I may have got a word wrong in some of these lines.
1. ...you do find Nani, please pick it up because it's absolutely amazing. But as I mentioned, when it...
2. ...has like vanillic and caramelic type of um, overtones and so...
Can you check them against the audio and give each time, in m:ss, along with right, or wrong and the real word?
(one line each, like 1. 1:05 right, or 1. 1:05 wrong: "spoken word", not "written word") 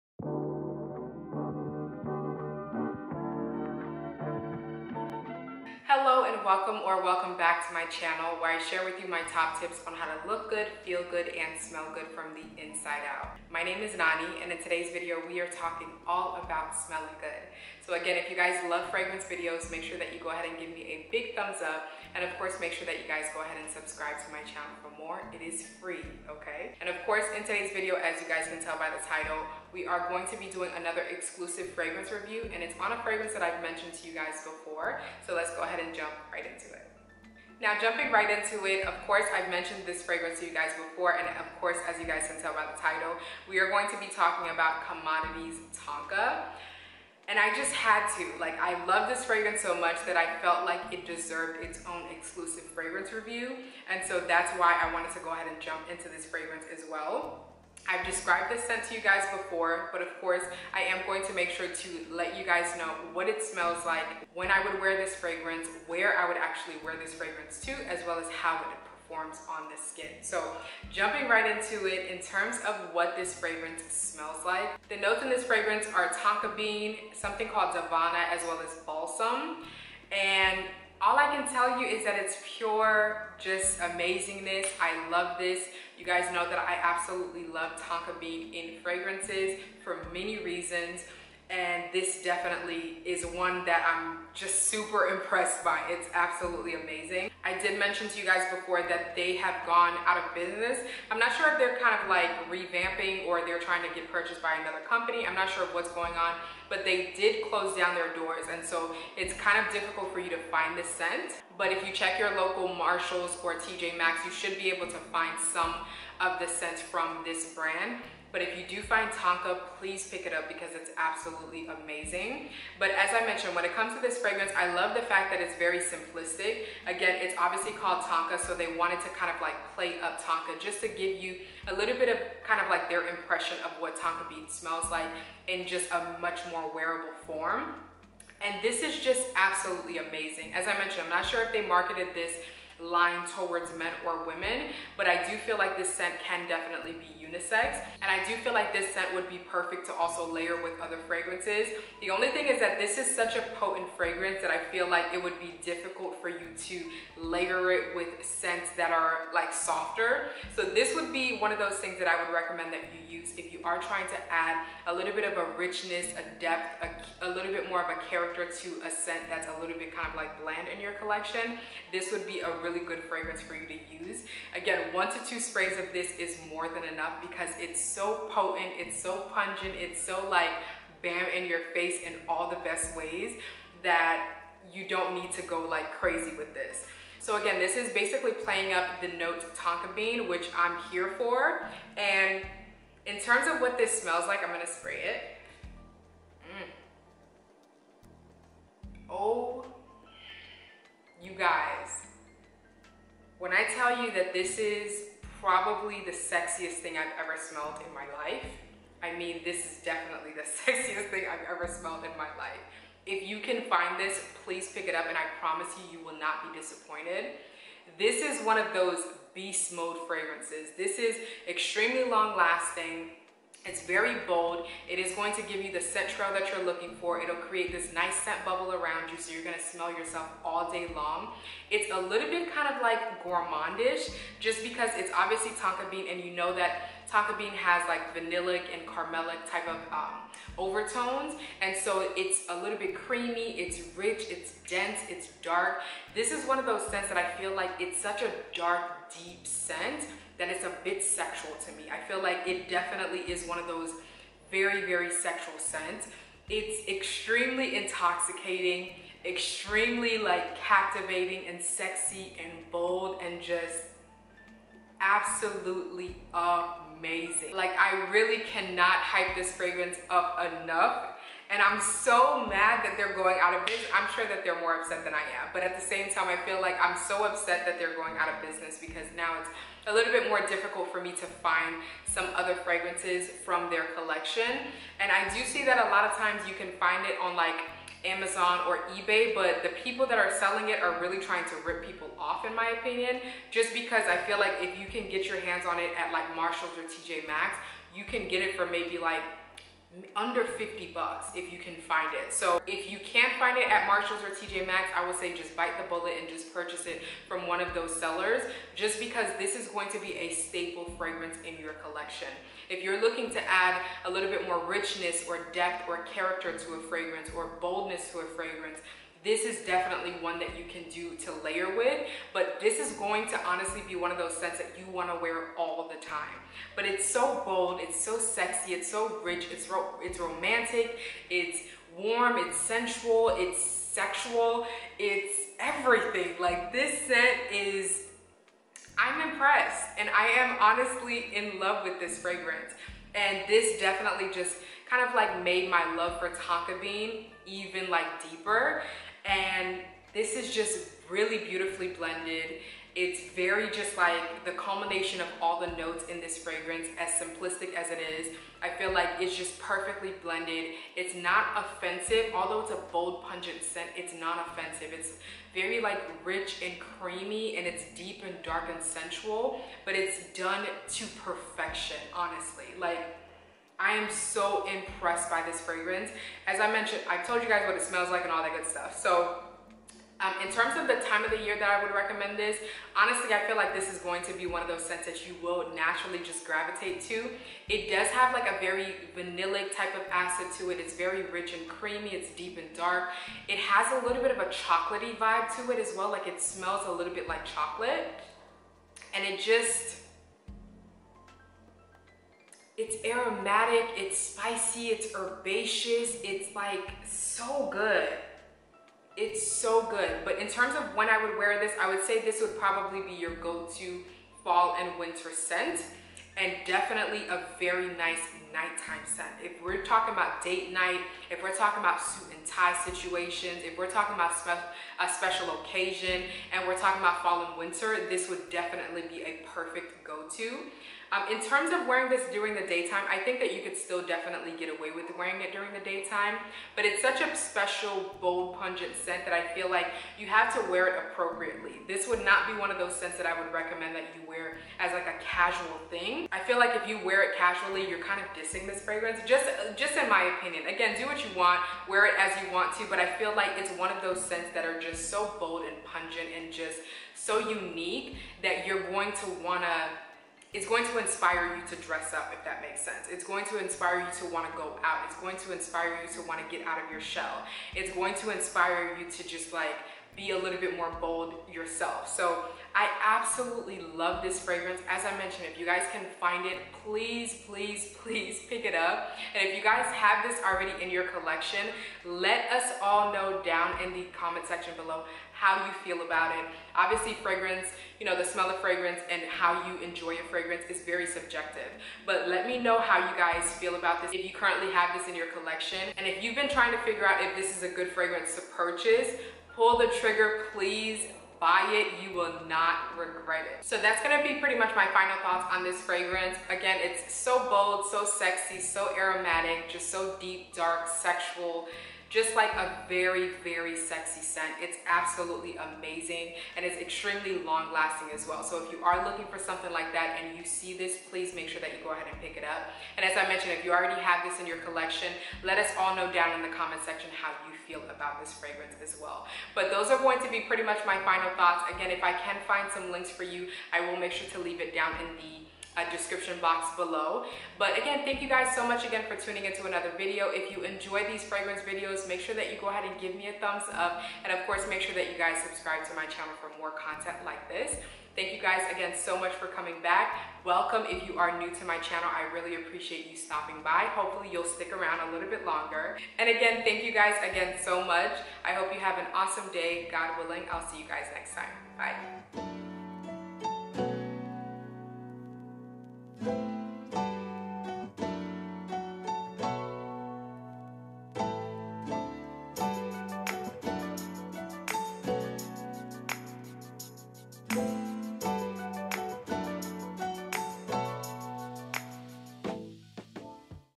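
1. 1:58 wrong: "Tonka", not "Nani"
2. 3:57 right.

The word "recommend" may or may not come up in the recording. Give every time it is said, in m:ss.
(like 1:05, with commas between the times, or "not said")
2:42, 6:21, 7:23.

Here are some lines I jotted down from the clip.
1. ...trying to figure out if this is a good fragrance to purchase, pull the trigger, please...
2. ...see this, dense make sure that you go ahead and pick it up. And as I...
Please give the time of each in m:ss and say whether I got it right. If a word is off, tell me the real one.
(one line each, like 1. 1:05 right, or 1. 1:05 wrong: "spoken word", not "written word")
1. 8:16 right
2. 8:40 wrong: "please", not "dense".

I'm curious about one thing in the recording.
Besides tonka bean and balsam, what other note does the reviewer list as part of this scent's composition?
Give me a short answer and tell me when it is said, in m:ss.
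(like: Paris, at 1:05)
Davana, at 1:17.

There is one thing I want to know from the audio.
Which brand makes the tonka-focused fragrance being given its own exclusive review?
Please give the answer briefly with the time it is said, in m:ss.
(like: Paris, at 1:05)
Commodity, at 0:44.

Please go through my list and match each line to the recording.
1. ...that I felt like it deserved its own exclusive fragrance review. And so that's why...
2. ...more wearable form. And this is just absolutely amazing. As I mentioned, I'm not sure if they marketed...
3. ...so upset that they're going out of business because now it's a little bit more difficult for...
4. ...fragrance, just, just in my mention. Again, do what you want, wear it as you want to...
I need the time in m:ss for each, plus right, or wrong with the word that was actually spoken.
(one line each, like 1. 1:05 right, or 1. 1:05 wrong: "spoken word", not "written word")
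1. 0:50 right
2. 2:16 right
3. 4:36 right
4. 7:28 wrong: "opinion", not "mention".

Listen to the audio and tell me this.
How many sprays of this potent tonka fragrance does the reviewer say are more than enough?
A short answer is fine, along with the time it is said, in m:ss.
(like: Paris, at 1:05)
1 to 2, at 2:54.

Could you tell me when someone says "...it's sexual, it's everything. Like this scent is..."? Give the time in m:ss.
5:33.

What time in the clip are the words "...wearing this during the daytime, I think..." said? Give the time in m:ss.
7:11.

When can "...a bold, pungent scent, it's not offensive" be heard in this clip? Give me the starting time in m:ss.
6:02.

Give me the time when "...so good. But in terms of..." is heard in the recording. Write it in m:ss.
6:49.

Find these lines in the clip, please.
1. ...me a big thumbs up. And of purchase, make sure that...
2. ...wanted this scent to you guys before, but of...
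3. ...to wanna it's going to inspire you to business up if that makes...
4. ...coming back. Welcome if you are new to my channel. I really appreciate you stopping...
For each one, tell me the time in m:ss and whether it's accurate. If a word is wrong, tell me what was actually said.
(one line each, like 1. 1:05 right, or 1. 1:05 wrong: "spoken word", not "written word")
1. 0:20 wrong: "course", not "purchase"
2. 0:58 wrong: "described", not "wanted"
3. 7:39 wrong: "dress", not "business"
4. 9:09 right.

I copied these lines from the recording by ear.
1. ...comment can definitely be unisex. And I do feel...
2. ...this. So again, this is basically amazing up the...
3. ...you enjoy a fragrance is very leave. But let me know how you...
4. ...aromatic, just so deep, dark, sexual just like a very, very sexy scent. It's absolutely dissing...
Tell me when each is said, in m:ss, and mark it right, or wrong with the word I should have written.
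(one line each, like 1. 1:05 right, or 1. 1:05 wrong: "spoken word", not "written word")
1. 2:25 wrong: "scent", not "comment"
2. 3:06 wrong: "playing", not "amazing"
3. 8:09 wrong: "subjective", not "leave"
4. 8:28 wrong: "amazing", not "dissing".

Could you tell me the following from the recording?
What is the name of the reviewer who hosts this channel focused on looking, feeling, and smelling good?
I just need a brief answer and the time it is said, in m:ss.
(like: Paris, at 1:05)
Nani, at 0:13.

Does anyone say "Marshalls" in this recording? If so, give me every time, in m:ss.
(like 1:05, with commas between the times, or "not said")
1:52, 4:56, 5:03.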